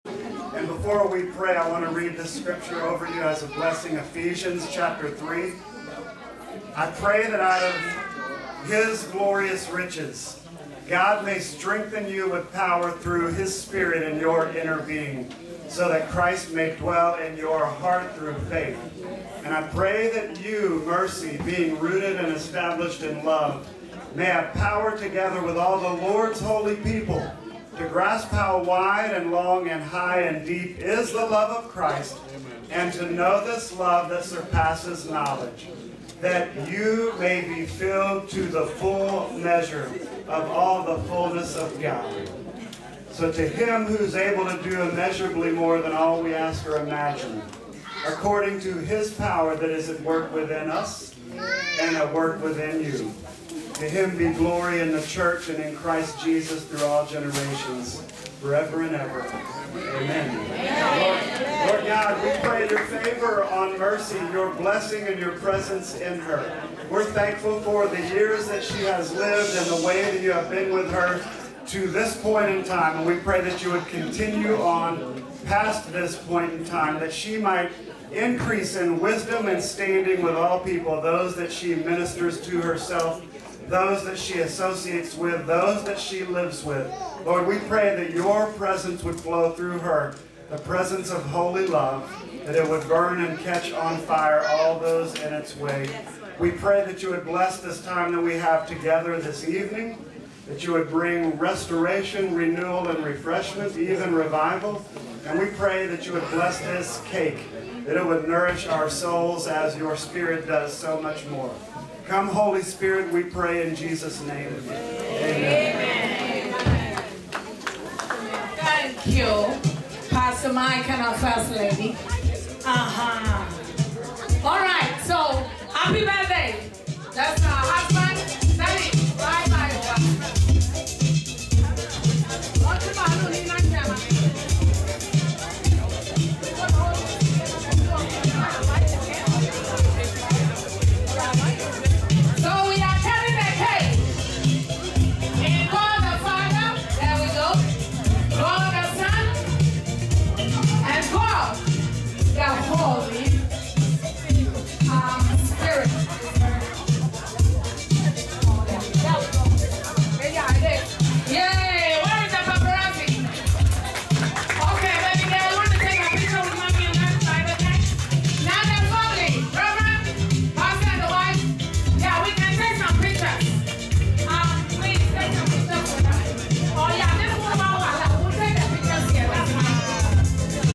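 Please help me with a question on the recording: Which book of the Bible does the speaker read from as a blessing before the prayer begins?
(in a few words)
Ephesians.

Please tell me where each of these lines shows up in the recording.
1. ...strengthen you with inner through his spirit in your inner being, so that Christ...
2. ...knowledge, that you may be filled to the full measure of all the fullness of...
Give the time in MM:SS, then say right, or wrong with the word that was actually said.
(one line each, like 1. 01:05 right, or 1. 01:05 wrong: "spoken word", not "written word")
1. 00:11 wrong: "power", not "inner"
2. 00:35 right.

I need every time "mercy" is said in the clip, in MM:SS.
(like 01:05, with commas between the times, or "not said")
00:20, 01:03.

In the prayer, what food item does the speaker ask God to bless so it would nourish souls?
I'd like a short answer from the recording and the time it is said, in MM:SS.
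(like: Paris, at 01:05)
cake, at 01:47.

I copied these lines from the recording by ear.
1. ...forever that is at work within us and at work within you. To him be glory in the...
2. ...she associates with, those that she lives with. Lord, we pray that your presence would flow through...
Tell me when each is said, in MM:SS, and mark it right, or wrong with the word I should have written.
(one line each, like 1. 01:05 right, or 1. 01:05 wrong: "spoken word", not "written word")
1. 00:49 wrong: "power", not "forever"
2. 01:24 right.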